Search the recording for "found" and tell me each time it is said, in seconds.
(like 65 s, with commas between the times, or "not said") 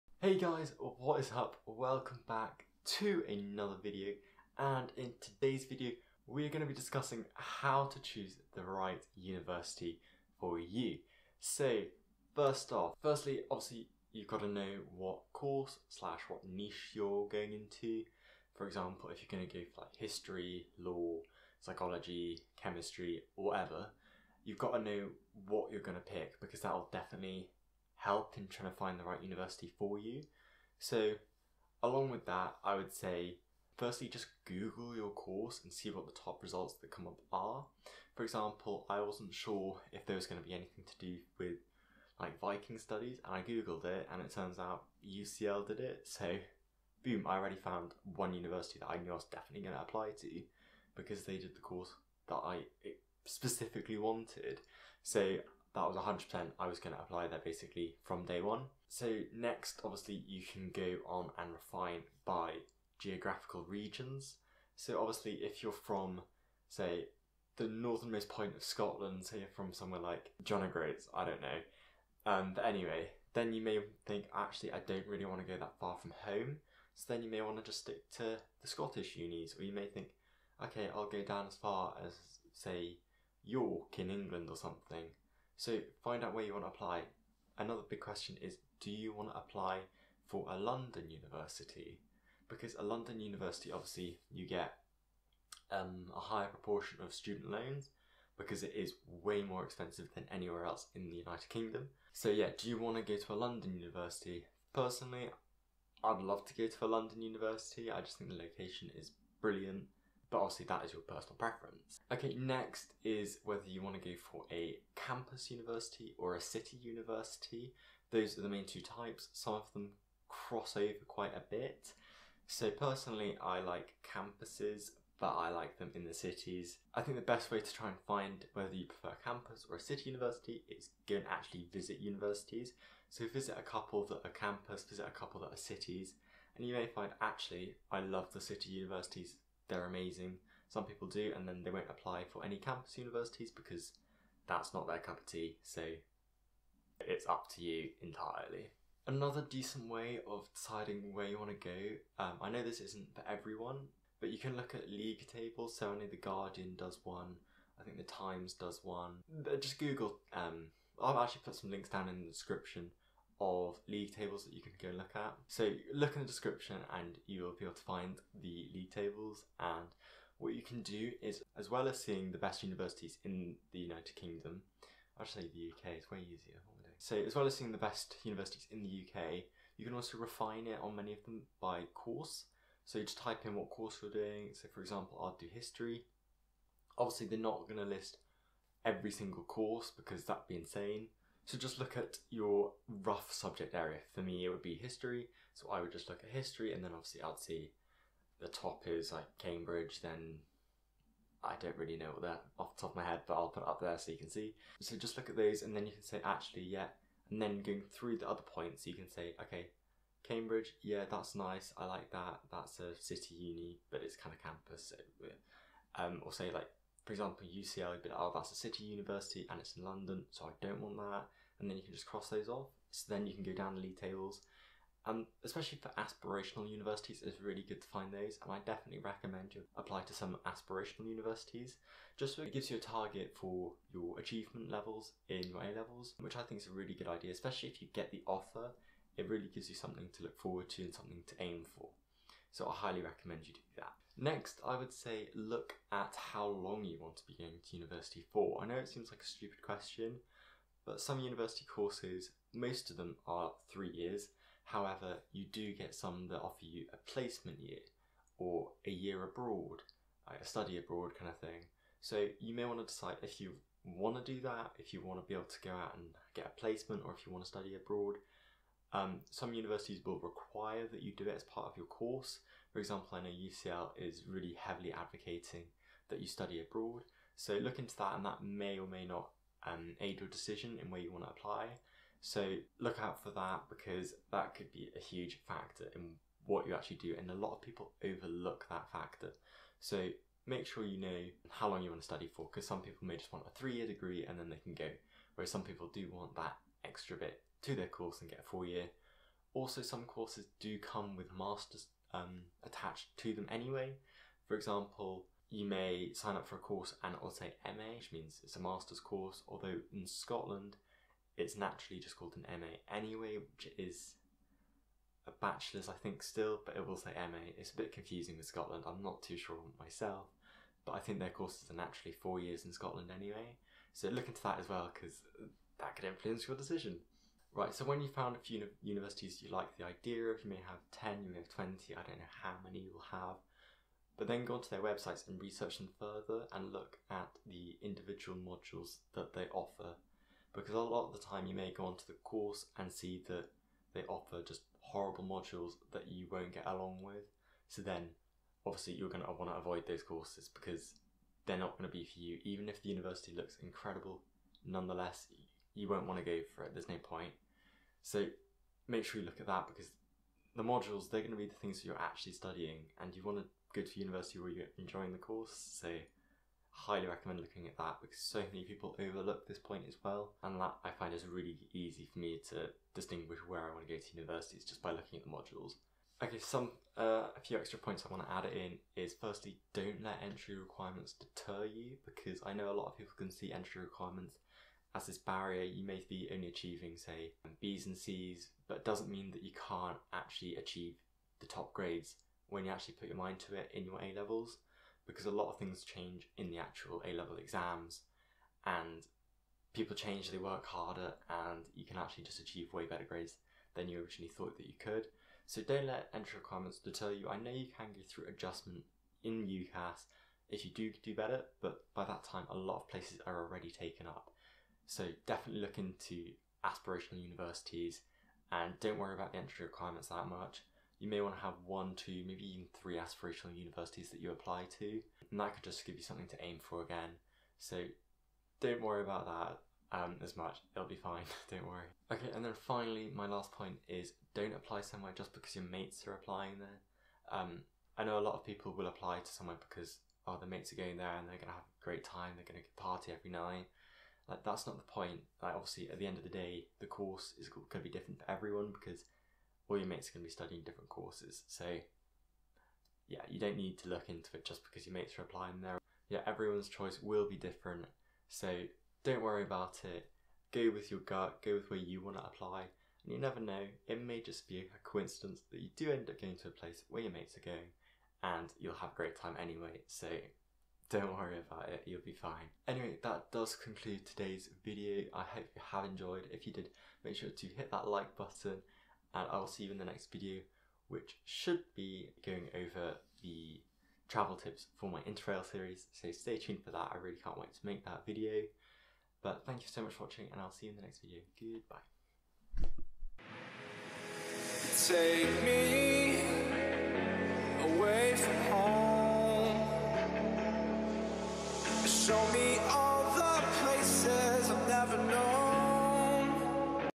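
47 s, 328 s.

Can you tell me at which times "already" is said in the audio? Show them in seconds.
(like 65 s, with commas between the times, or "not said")
47 s, 413 s.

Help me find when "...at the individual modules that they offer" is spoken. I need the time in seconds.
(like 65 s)
337 s.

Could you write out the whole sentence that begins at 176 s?
So as well as seeing the best universities in the UK, you can also refine it on many of them by course.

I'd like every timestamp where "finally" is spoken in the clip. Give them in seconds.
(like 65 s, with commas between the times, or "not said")
432 s.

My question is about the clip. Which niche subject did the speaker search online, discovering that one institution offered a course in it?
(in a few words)
Viking studies.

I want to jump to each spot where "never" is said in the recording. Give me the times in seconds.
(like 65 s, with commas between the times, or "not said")
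463 s.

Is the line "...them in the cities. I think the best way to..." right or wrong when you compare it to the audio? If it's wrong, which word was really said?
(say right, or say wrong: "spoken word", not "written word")
right.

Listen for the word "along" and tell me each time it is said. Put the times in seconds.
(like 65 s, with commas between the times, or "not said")
31 s, 346 s.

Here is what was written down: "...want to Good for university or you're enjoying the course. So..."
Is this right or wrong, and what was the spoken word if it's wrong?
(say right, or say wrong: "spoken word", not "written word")
right.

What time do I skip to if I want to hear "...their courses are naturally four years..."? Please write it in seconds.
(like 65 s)
321 s.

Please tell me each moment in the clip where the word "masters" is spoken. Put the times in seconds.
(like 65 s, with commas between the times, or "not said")
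301 s, 308 s.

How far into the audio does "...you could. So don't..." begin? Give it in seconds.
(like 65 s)
404 s.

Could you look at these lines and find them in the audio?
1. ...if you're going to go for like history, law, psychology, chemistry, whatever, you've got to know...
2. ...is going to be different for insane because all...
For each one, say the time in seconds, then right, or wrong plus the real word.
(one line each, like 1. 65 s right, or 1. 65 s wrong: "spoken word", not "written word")
1. 19 s right
2. 447 s wrong: "everyone", not "insane".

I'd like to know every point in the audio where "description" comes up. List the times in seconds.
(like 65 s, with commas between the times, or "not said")
162 s, 166 s.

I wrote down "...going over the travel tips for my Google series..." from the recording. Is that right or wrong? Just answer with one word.
wrong.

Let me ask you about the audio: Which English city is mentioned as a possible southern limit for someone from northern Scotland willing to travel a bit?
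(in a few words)
York.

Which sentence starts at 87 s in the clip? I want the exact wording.
Another big question is do you want to apply for a London university?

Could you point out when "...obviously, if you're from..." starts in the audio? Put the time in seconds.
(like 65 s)
64 s.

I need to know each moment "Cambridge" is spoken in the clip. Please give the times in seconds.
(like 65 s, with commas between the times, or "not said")
199 s, 210 s.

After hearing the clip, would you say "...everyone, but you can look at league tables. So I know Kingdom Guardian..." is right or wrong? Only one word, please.
wrong.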